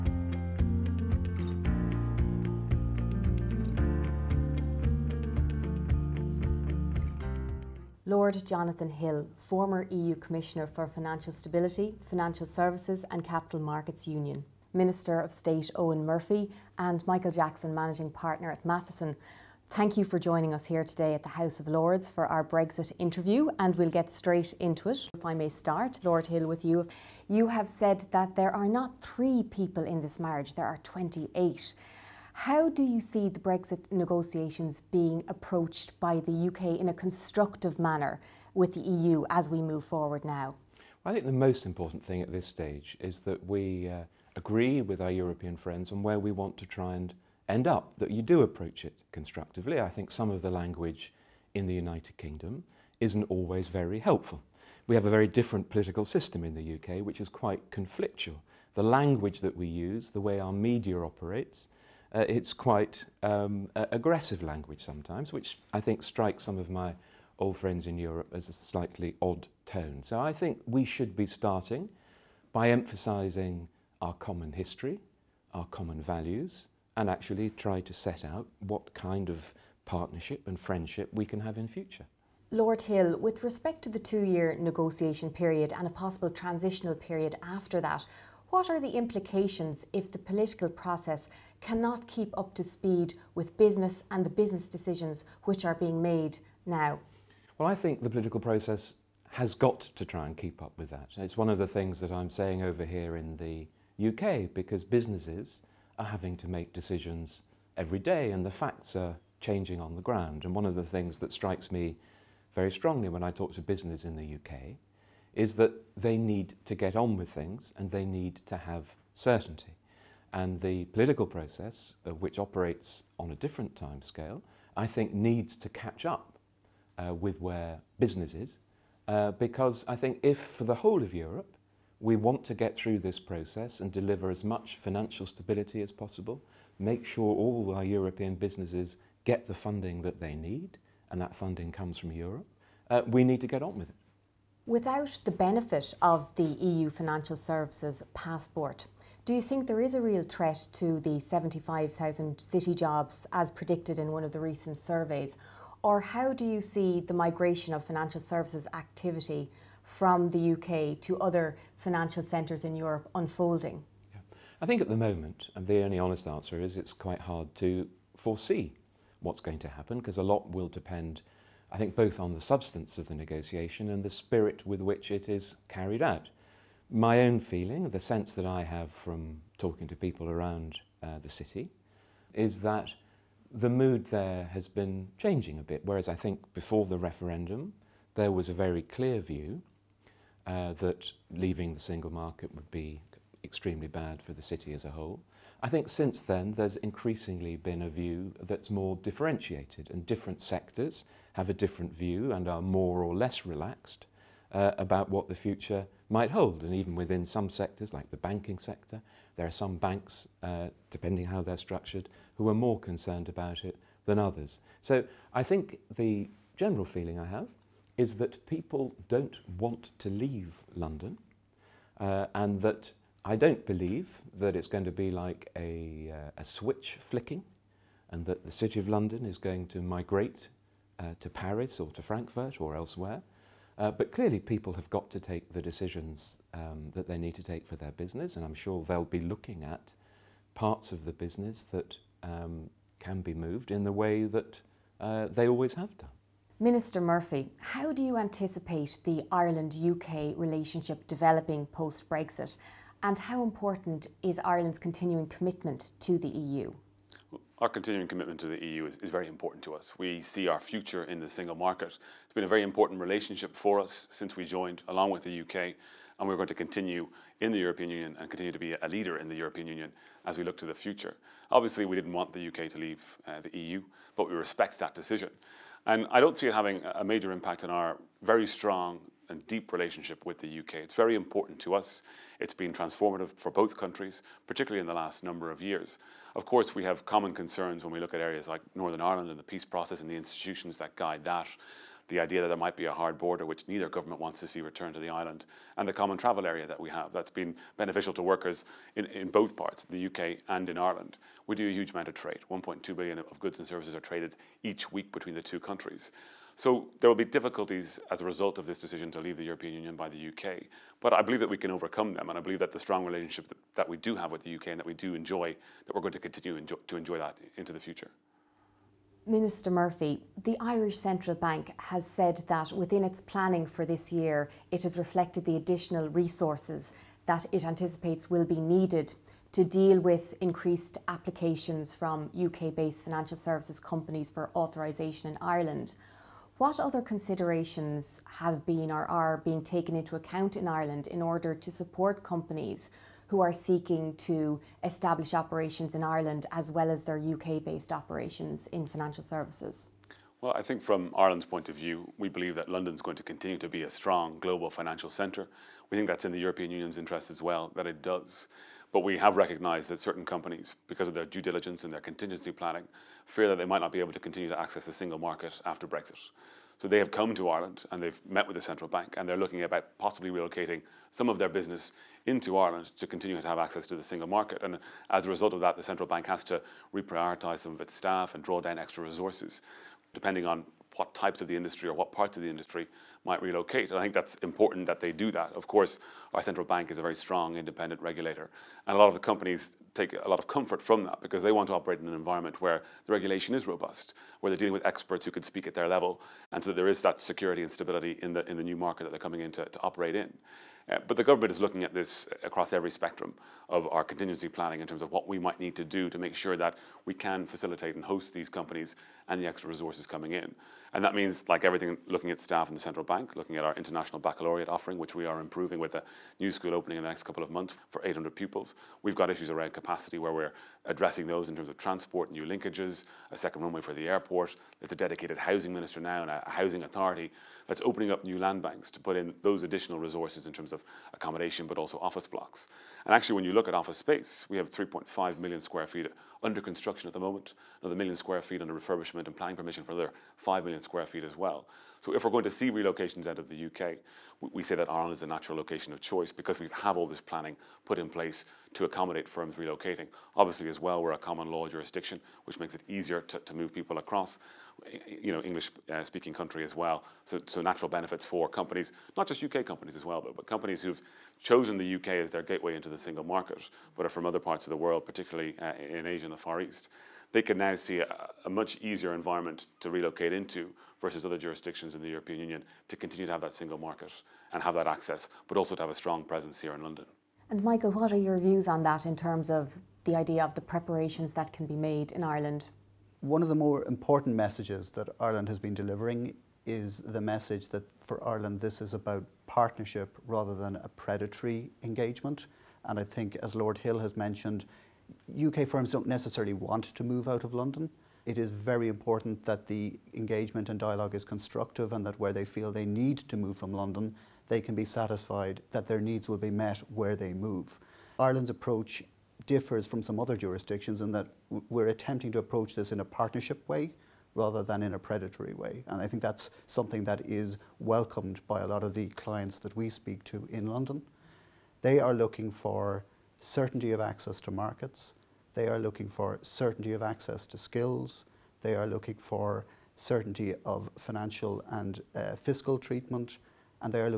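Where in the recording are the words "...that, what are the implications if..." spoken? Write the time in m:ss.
1:27.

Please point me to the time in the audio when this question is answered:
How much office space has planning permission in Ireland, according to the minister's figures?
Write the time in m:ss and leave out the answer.
7:20.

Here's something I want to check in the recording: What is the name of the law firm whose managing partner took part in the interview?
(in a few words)
Matheson.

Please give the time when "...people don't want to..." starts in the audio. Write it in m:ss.
3:38.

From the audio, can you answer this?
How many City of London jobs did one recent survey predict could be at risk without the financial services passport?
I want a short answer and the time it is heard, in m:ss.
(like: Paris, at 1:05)
75,000, at 2:31.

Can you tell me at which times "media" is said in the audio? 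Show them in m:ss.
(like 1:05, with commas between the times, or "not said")
1:00.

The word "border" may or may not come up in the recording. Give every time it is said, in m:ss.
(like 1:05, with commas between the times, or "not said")
4:53.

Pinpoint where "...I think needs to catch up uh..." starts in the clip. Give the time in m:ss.
2:04.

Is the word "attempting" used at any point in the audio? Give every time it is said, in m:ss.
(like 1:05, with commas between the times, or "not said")
8:31.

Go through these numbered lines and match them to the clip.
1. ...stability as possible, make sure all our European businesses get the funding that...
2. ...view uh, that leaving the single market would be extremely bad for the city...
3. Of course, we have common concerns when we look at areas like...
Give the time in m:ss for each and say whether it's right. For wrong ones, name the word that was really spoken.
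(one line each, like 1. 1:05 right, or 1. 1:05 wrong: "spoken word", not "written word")
1. 2:15 right
2. 3:09 right
3. 4:46 right.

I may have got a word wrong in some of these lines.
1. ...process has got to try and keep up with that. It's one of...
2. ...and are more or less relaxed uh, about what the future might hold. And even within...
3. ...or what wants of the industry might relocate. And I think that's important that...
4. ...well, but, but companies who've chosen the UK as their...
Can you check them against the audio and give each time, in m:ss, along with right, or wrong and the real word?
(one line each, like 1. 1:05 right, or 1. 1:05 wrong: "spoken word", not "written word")
1. 1:38 right
2. 3:22 right
3. 6:21 wrong: "parts", not "wants"
4. 7:40 right.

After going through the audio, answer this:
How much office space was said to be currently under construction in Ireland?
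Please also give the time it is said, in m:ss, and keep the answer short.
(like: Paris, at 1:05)
3.5 million square feet, at 7:14.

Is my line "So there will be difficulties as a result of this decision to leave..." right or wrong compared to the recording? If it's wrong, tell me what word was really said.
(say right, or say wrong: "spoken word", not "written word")
right.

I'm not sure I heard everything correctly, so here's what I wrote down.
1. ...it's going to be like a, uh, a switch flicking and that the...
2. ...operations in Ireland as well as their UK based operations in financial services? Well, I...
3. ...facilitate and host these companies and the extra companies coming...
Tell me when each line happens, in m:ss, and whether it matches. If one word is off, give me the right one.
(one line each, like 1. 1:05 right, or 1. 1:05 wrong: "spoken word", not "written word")
1. 3:44 right
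2. 5:45 right
3. 6:47 wrong: "resources", not "companies".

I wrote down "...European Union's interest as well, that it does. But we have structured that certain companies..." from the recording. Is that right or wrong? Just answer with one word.
wrong.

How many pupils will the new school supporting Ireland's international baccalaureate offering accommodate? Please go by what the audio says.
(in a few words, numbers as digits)
800.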